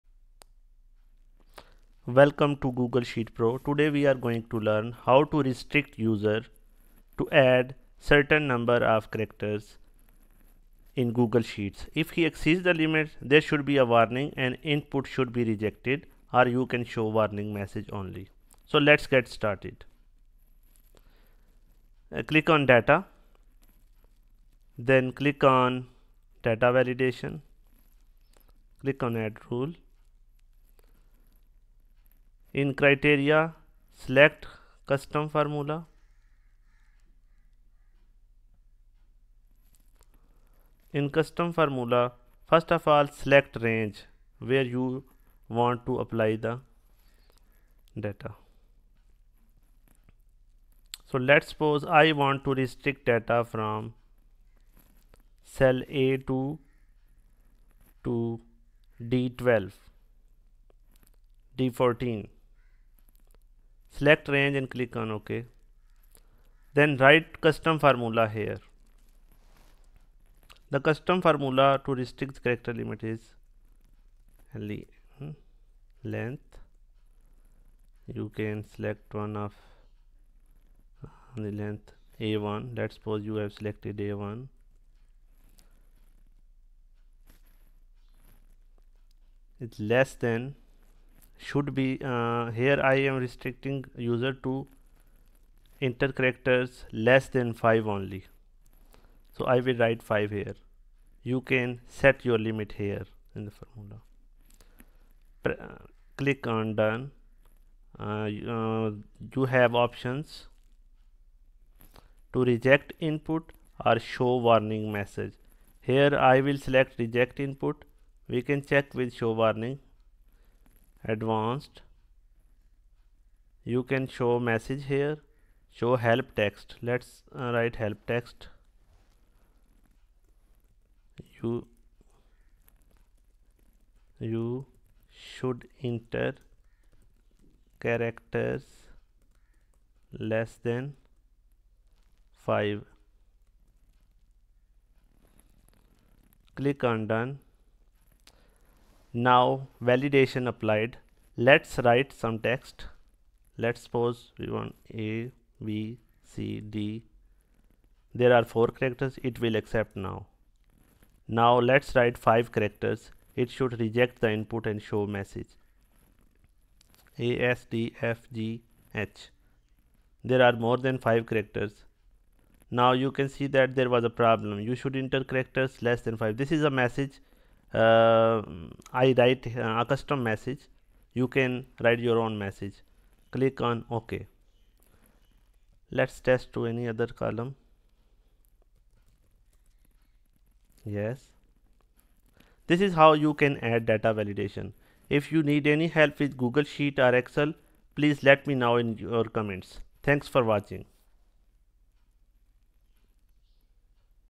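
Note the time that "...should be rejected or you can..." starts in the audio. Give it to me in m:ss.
0:15.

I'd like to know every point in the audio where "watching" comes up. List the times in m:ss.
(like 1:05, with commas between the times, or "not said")
3:20.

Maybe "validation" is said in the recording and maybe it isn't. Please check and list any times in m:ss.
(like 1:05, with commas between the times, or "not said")
0:26, 2:29, 3:14.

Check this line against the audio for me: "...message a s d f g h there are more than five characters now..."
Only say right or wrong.
right.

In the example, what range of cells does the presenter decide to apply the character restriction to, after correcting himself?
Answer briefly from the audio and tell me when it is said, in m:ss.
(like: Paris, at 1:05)
A2 to D14, at 0:55.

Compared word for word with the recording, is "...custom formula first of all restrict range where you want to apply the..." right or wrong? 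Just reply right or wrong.
wrong.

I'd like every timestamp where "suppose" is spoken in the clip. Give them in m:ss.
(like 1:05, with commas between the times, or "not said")
0:51, 1:22, 2:33.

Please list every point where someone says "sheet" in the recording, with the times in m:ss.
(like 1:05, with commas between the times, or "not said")
0:03, 0:11, 3:16.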